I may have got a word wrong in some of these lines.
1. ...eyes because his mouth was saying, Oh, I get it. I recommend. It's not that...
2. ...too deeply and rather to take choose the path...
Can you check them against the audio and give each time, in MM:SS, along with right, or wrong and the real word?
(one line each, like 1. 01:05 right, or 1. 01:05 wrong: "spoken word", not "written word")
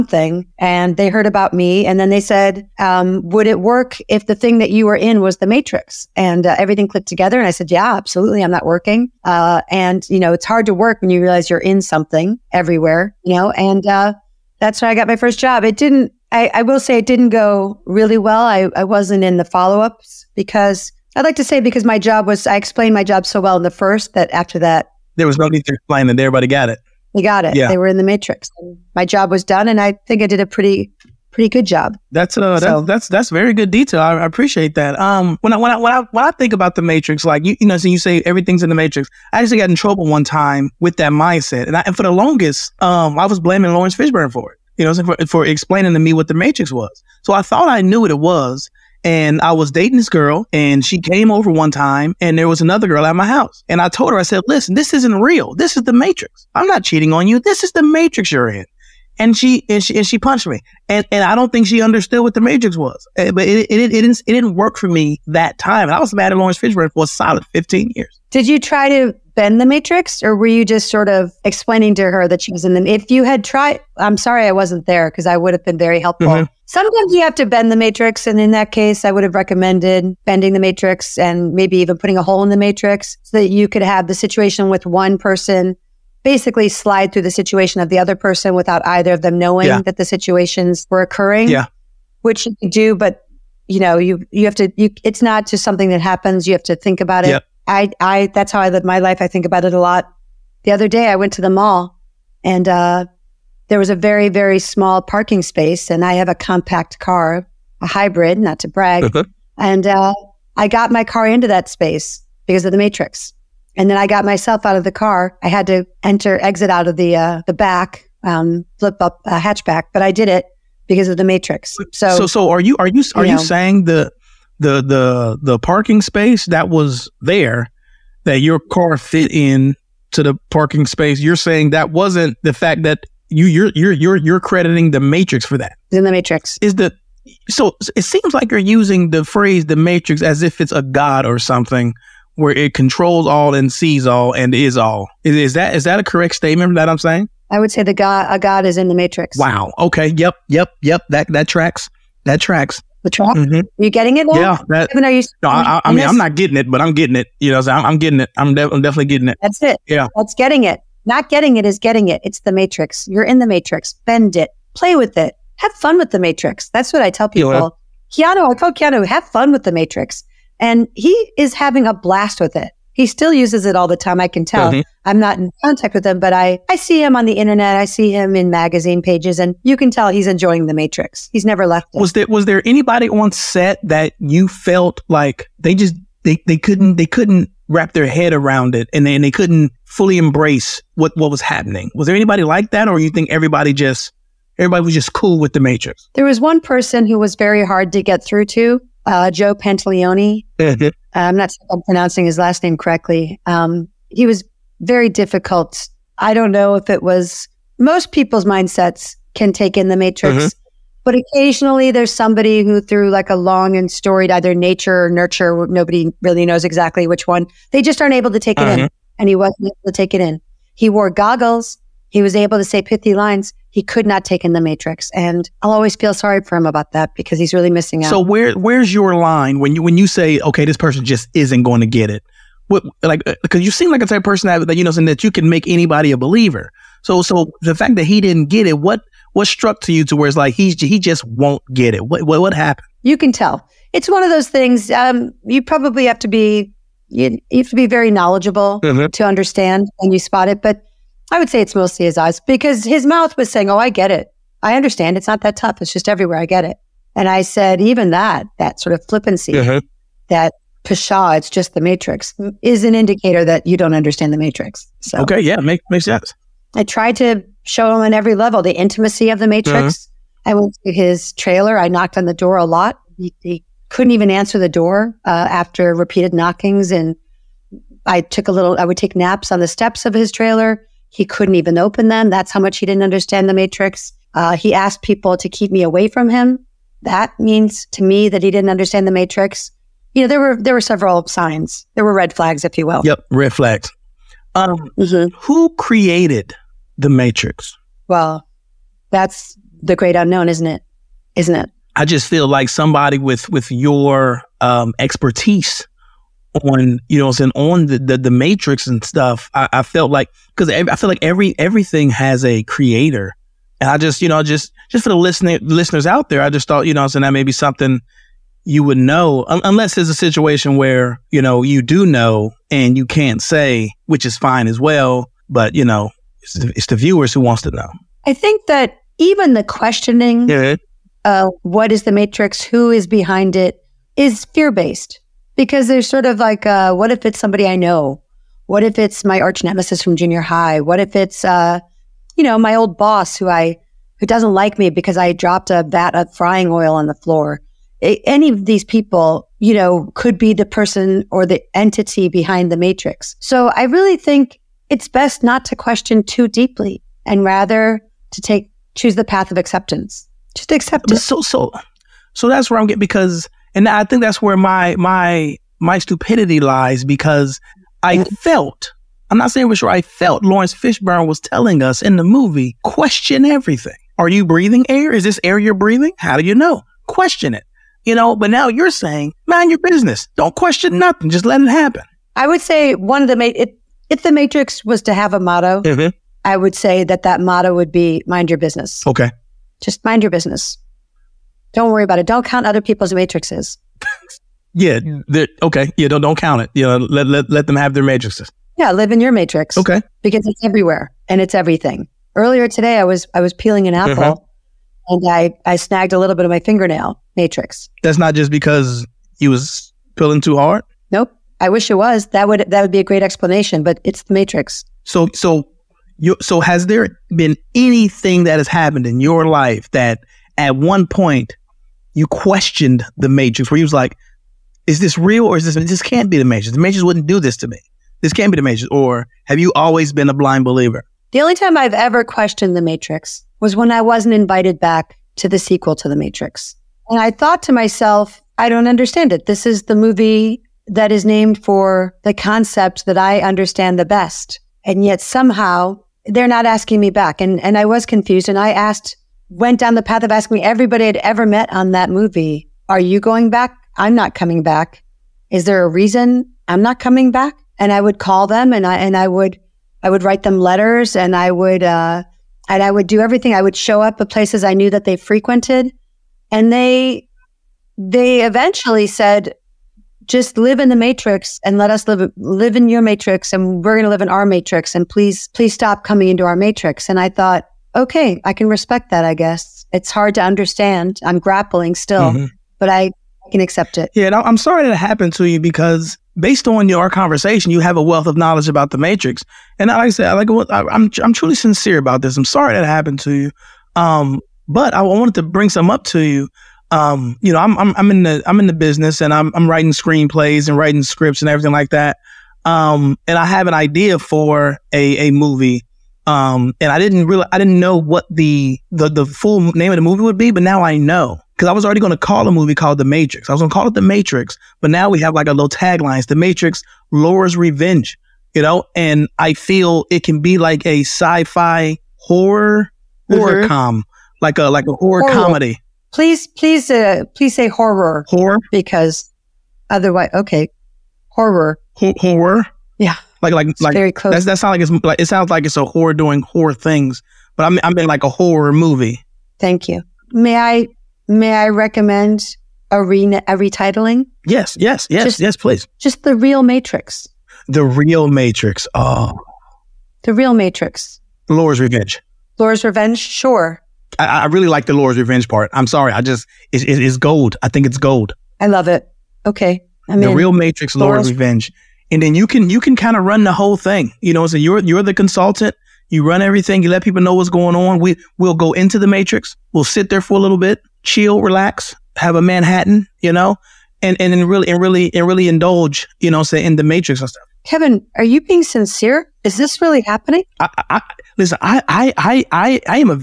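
1. 04:12 wrong: "understand", not "recommend"
2. 05:56 right.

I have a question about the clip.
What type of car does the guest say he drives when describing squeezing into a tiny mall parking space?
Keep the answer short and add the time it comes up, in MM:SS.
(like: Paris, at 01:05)
A hybrid, at 01:47.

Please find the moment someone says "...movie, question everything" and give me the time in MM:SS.
06:12.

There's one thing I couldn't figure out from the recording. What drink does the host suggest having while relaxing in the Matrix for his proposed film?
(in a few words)
A Manhattan.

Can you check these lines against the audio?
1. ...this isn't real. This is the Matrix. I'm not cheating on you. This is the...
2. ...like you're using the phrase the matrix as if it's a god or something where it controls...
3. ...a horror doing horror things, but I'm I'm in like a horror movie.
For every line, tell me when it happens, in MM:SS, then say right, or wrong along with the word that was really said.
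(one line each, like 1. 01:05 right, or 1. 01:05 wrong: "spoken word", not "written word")
1. 00:54 right
2. 02:18 right
3. 08:55 right.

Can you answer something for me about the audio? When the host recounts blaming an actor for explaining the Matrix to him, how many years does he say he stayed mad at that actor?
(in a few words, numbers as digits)
15.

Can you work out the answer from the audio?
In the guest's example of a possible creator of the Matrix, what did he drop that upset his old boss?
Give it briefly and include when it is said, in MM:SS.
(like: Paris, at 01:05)
A vat of frying oil, at 05:45.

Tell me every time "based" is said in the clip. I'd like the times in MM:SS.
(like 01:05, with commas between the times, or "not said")
05:34, 08:06.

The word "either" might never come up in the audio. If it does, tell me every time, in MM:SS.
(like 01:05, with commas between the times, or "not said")
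01:28, 03:34.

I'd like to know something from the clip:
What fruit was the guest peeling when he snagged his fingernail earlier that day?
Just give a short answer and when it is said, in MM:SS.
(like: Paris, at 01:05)
An apple, at 06:43.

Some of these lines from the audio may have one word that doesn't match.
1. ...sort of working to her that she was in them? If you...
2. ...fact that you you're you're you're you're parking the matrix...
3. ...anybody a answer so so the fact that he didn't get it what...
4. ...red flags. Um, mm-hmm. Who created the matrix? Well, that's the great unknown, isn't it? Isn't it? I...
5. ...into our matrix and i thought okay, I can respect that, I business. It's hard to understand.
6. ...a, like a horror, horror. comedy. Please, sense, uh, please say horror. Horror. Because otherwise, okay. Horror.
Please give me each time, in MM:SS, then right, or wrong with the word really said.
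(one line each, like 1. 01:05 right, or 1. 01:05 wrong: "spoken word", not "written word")
1. 01:10 wrong: "explaining", not "working"
2. 02:12 wrong: "crediting", not "parking"
3. 03:55 wrong: "believer", not "answer"
4. 04:53 right
5. 07:56 wrong: "guess", not "business"
6. 08:44 wrong: "please", not "sense".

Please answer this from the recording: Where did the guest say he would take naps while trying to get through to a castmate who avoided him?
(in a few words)
Steps of his trailer.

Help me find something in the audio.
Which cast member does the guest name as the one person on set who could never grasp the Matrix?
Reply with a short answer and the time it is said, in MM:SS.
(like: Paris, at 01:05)
Joe Pantaleone, at 03:19.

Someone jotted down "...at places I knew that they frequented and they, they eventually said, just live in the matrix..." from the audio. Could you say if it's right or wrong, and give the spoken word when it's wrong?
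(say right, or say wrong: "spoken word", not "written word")
right.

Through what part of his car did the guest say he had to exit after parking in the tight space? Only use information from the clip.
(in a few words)
Hatchback.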